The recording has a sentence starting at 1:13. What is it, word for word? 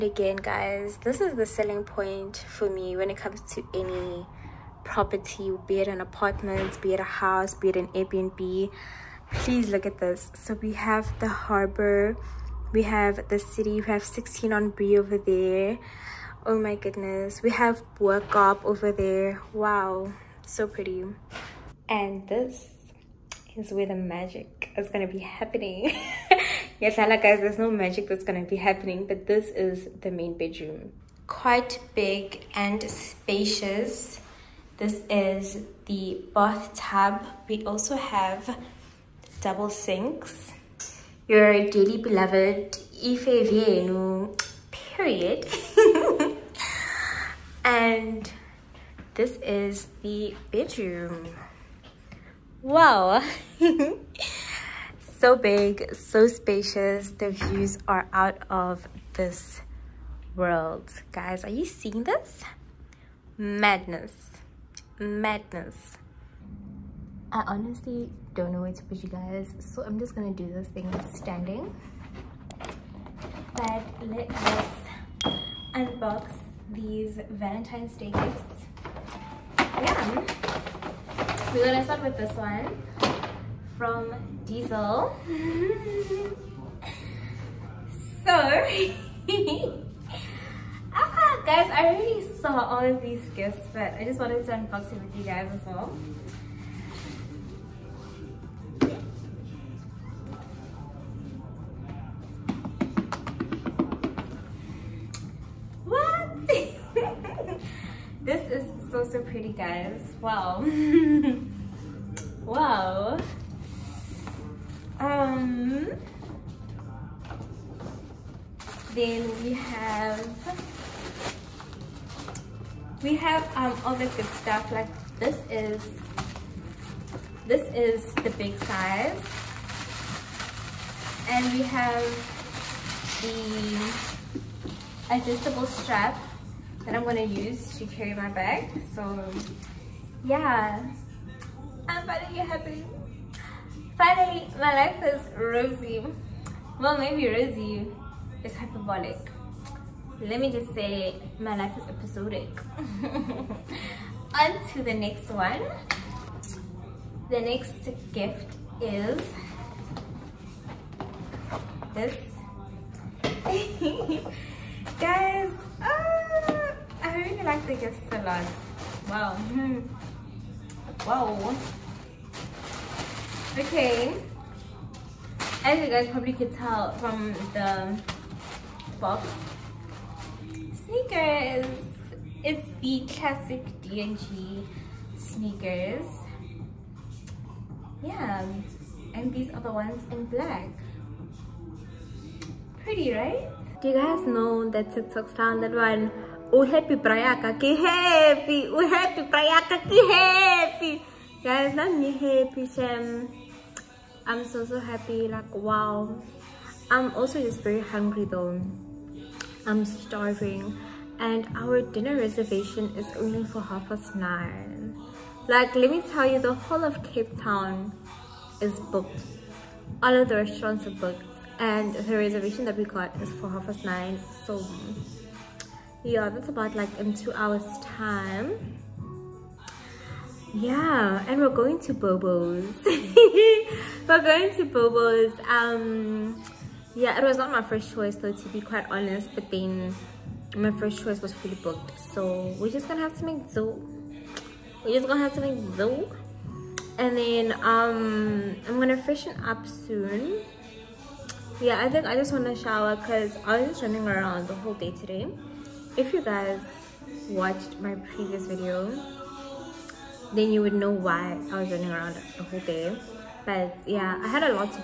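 But let us unbox these Valentine's Day gifts.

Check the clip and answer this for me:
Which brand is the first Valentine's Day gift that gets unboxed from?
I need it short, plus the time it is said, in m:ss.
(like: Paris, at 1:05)
Diesel, at 1:24.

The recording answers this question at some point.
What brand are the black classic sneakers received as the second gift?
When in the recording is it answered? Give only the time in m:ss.
3:03.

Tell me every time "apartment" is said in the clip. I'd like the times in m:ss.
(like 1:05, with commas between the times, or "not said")
0:06.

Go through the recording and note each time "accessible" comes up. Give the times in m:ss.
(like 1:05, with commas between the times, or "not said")
not said.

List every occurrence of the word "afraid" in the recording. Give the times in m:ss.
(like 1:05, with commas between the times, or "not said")
not said.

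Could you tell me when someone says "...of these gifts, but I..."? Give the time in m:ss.
1:32.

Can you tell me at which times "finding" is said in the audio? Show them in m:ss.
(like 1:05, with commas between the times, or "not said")
2:22.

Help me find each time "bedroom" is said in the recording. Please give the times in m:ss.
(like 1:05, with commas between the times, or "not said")
0:30, 0:50.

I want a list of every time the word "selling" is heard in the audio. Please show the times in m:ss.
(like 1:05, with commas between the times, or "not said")
0:01.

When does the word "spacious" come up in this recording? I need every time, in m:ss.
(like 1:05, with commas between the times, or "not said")
0:32, 0:56.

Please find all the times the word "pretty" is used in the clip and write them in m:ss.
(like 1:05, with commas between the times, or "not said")
0:20, 1:49, 3:12.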